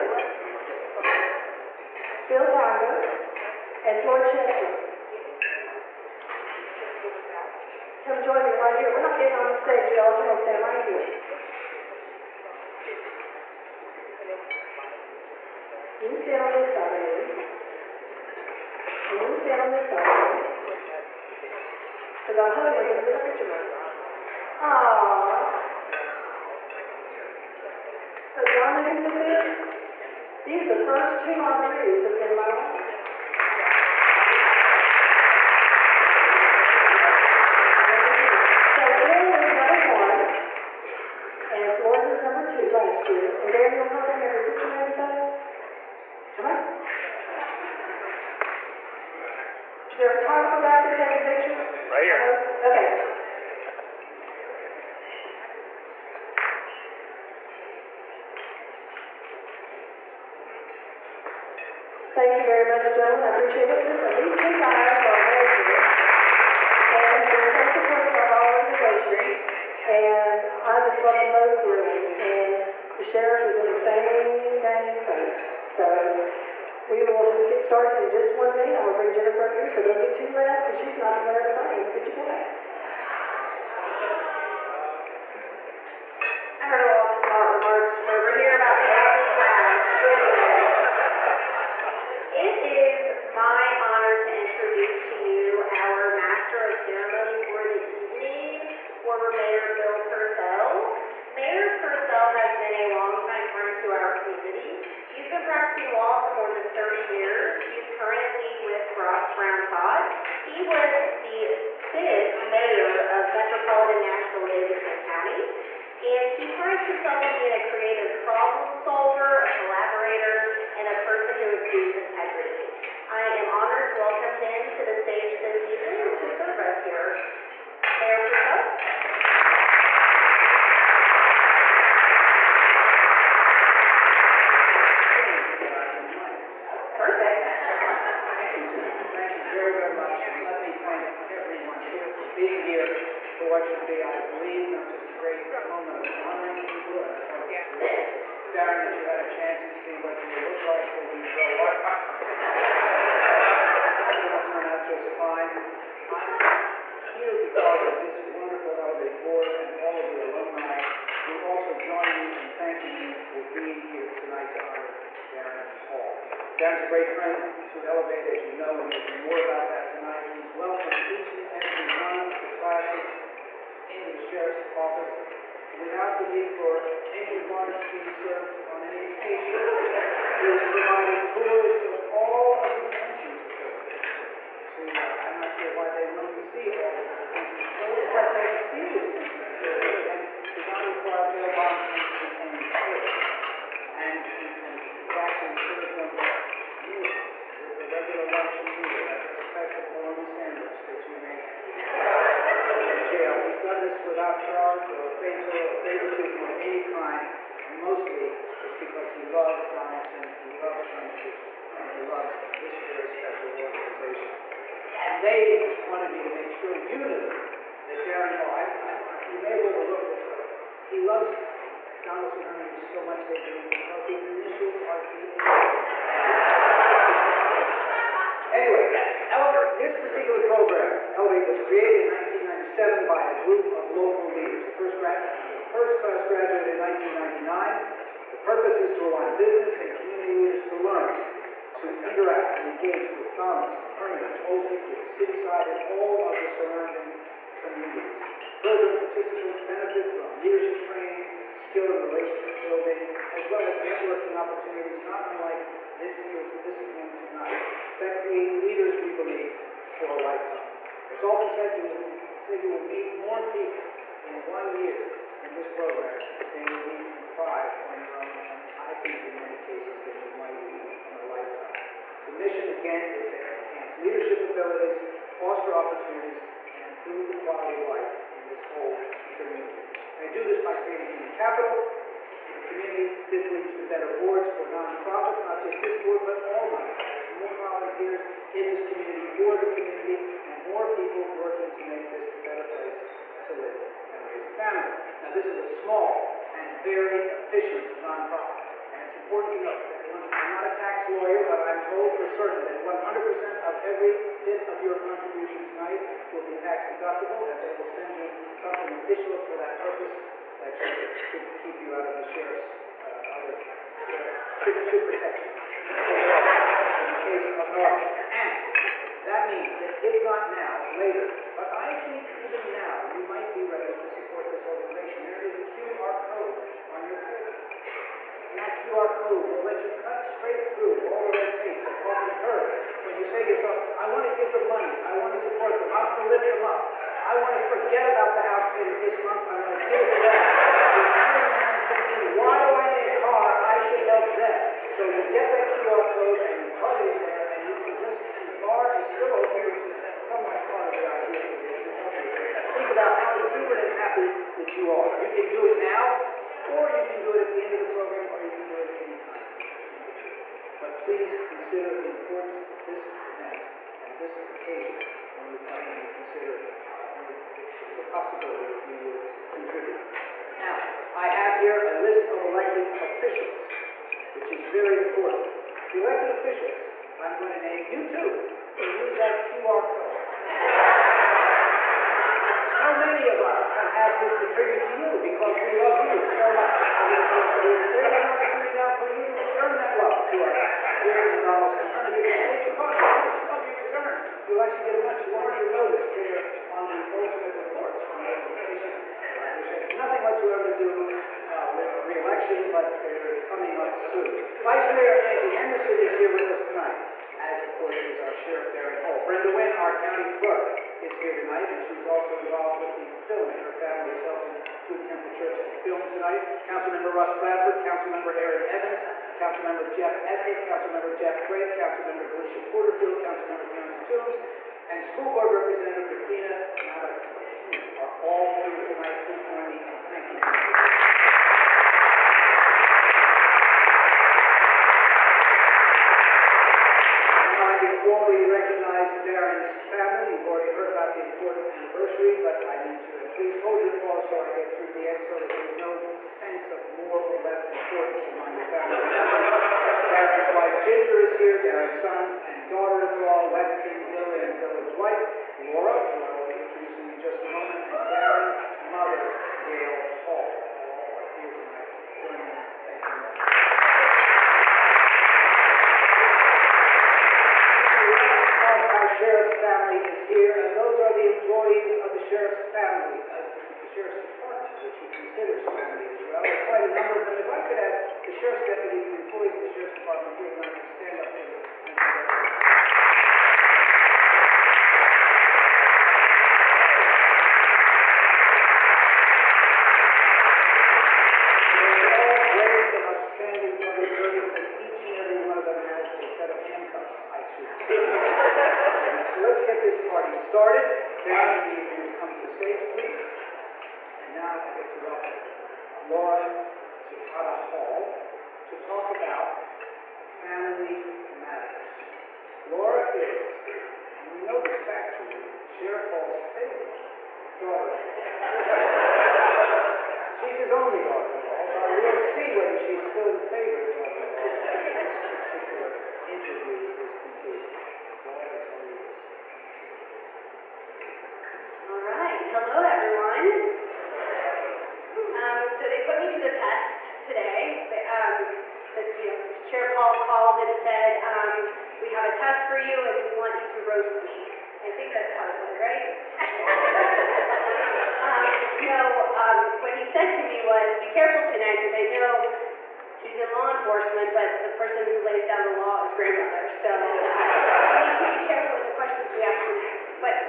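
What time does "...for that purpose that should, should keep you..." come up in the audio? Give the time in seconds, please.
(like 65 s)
309 s.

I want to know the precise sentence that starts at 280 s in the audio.
They do this by creating human capital in the community.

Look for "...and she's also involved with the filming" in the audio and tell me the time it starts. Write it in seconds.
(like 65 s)
411 s.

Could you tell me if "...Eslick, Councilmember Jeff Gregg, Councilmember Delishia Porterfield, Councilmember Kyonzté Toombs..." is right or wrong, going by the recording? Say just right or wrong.
right.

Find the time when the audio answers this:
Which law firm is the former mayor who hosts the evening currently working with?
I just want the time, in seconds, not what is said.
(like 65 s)
108 s.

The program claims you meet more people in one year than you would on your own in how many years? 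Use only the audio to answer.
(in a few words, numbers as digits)
5.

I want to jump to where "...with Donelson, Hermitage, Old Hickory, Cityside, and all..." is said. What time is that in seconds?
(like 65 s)
243 s.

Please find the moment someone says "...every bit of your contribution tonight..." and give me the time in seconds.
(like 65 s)
303 s.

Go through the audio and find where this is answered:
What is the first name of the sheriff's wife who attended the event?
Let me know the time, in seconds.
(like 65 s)
450 s.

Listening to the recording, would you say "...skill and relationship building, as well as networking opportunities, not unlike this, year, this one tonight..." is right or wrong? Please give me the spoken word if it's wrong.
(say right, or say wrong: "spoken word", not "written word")
right.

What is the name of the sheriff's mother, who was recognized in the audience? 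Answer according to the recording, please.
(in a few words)
Gail Hall.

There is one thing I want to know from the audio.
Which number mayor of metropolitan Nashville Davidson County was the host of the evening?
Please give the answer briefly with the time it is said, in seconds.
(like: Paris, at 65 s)
5th, at 111 s.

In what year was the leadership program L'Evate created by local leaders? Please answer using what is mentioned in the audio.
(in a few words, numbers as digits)
1997.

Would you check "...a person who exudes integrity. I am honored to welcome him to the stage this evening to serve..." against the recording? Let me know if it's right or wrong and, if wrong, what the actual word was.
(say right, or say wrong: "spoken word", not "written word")
right.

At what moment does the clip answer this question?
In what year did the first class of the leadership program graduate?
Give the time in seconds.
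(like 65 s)
236 s.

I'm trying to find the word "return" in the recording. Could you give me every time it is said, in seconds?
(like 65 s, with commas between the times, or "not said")
389 s, 393 s.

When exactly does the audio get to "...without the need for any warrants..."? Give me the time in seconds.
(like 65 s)
175 s.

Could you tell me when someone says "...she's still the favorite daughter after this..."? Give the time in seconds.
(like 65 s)
522 s.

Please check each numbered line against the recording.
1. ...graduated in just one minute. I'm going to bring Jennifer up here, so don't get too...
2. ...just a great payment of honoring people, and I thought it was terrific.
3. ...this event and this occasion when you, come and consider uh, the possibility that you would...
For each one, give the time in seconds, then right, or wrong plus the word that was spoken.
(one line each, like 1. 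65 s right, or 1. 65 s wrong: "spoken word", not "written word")
1. 77 s wrong: "started", not "graduated"
2. 144 s wrong: "moment", not "payment"
3. 362 s right.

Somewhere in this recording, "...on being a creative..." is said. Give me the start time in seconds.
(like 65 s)
117 s.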